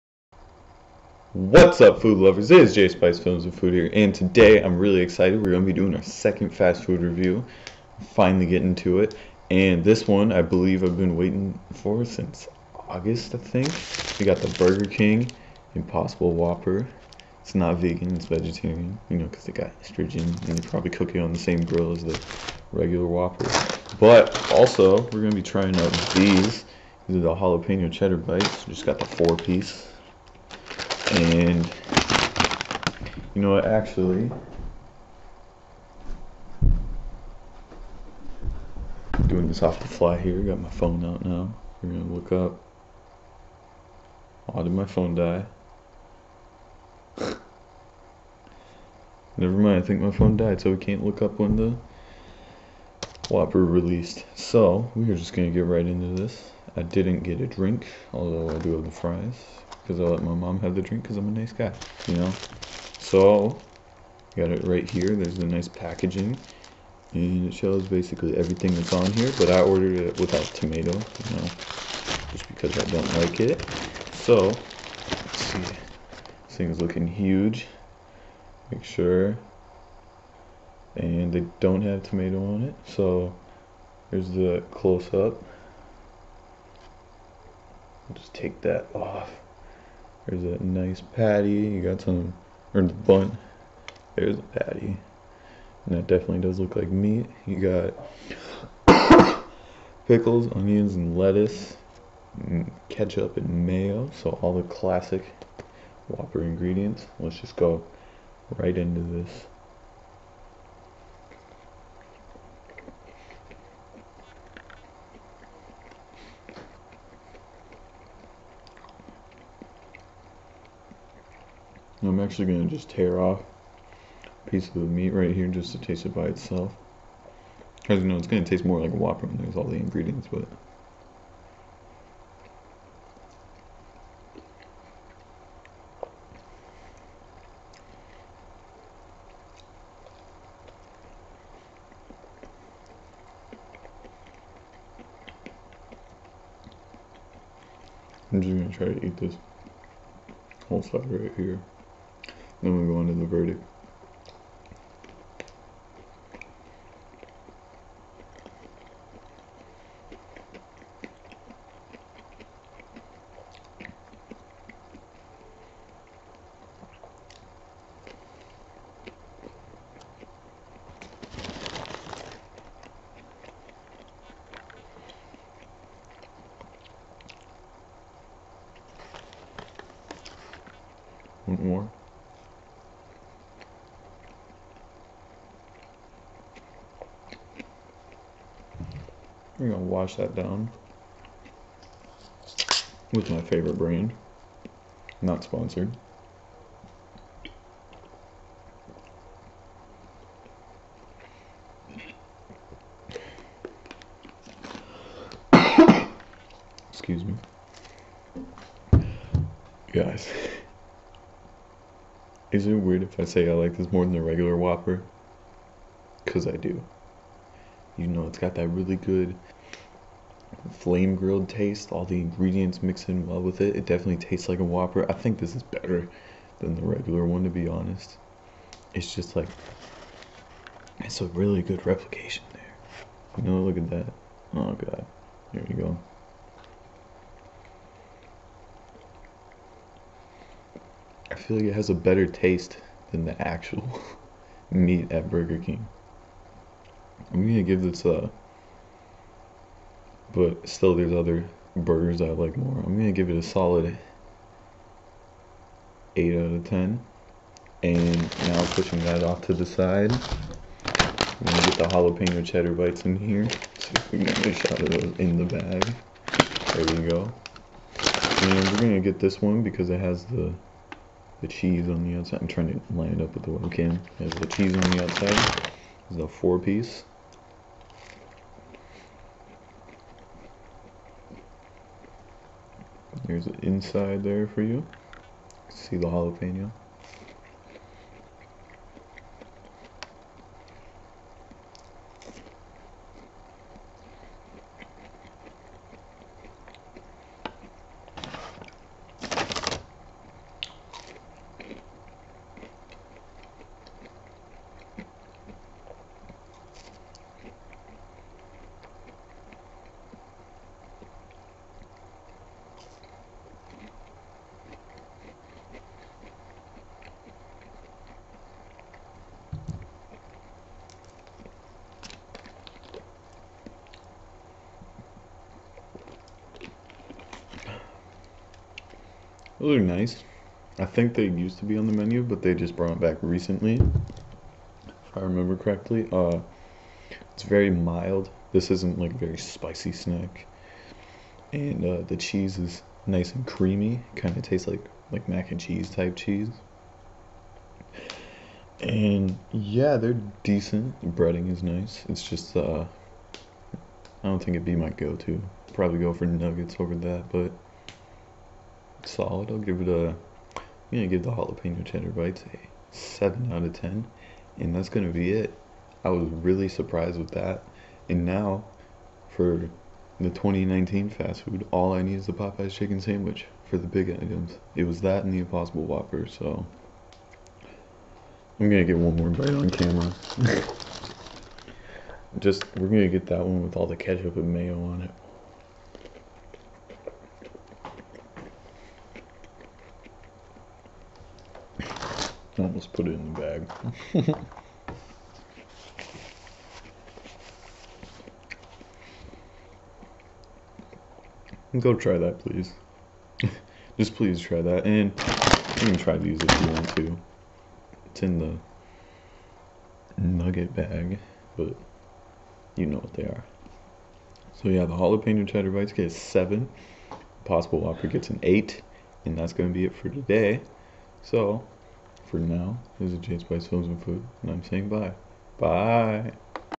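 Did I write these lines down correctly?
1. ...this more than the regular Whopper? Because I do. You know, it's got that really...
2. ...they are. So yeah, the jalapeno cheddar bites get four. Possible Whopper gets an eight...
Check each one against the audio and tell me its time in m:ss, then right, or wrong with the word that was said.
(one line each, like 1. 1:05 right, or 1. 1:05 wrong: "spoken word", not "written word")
1. 3:33 right
2. 6:53 wrong: "seven", not "four".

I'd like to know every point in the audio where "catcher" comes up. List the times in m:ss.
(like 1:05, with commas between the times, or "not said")
not said.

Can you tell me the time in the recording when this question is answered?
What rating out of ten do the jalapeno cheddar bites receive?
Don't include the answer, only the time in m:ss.
6:02.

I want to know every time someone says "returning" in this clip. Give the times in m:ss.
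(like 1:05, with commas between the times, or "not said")
not said.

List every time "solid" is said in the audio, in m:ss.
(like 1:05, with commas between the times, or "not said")
4:13, 5:59.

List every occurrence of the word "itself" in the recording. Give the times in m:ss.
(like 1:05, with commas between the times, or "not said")
2:06.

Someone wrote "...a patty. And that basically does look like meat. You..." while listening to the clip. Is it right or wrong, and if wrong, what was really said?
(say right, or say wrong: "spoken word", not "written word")
wrong: "definitely", not "basically".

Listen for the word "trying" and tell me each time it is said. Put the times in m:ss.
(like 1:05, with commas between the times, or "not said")
0:25, 4:32.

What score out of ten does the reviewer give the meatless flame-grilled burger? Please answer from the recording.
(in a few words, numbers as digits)
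8.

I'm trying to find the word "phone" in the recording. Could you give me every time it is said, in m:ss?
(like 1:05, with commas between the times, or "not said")
0:40, 0:44, 0:50.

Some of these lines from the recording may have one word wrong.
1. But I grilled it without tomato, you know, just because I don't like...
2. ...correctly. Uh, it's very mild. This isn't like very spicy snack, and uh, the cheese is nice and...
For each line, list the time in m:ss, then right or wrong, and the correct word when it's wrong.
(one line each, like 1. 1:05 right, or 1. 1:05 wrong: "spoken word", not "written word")
1. 1:09 wrong: "ordered", not "grilled"
2. 5:35 right.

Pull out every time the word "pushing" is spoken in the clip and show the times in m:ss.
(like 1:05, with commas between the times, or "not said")
4:18.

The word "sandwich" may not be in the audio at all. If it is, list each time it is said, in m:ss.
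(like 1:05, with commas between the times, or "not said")
6:12.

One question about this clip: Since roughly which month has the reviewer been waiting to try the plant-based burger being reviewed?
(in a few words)
August.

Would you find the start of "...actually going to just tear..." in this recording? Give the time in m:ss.
2:02.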